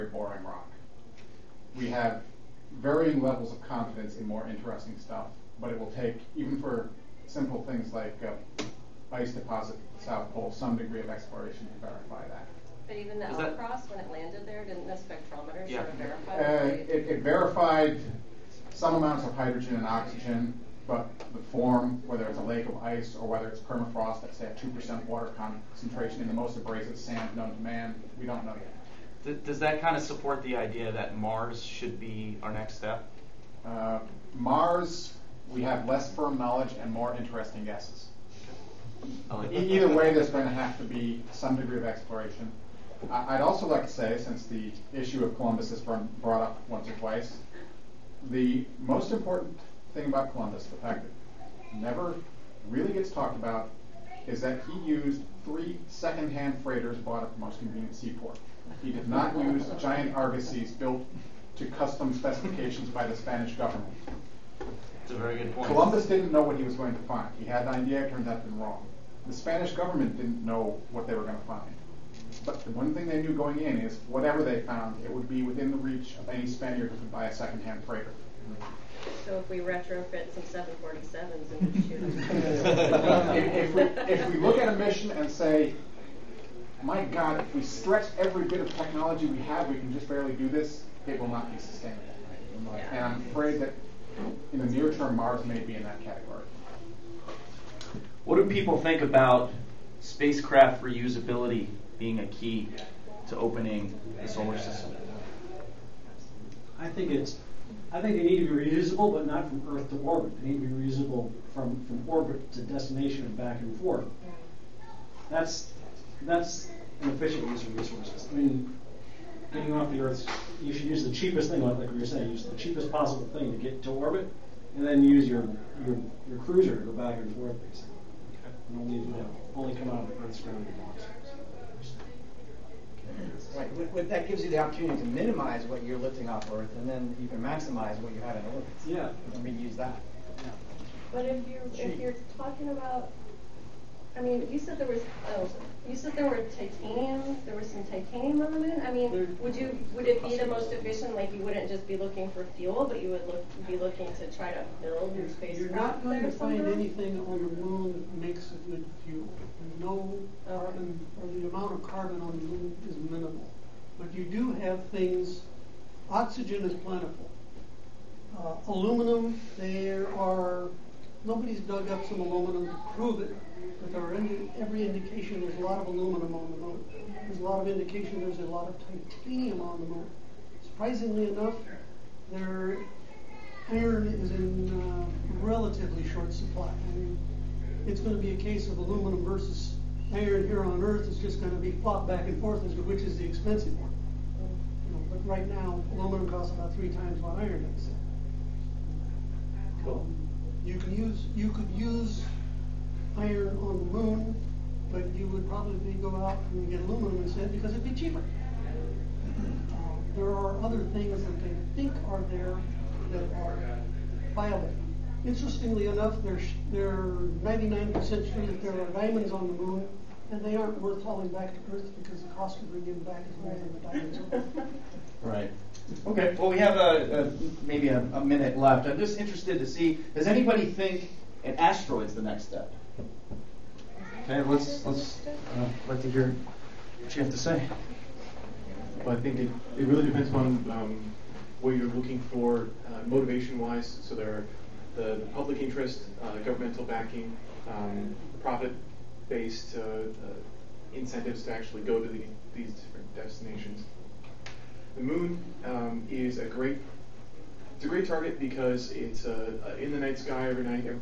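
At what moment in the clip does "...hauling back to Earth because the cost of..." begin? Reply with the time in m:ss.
3:41.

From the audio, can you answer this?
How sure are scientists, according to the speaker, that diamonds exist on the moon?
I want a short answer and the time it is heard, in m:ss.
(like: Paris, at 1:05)
99%, at 3:37.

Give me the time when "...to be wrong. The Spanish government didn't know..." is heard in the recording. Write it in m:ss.
1:08.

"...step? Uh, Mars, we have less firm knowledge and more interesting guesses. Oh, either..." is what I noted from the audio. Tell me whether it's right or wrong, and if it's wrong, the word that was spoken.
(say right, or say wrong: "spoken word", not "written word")
right.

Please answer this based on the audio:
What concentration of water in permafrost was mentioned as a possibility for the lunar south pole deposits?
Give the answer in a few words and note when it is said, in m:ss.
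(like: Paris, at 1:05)
2%, at 0:24.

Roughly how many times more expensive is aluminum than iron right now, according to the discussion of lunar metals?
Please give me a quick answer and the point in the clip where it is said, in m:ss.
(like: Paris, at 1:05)
3 times, at 3:16.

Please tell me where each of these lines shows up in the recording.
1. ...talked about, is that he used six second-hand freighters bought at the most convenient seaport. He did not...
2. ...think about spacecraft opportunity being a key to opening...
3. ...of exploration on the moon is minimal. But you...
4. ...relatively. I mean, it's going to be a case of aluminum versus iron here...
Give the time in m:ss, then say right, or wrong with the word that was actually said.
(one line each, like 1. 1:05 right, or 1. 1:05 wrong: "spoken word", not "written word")
1. 0:53 wrong: "three", not "six"
2. 1:38 wrong: "reusability", not "opportunity"
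3. 2:41 wrong: "carbon", not "exploration"
4. 3:06 wrong: "supply", not "relatively".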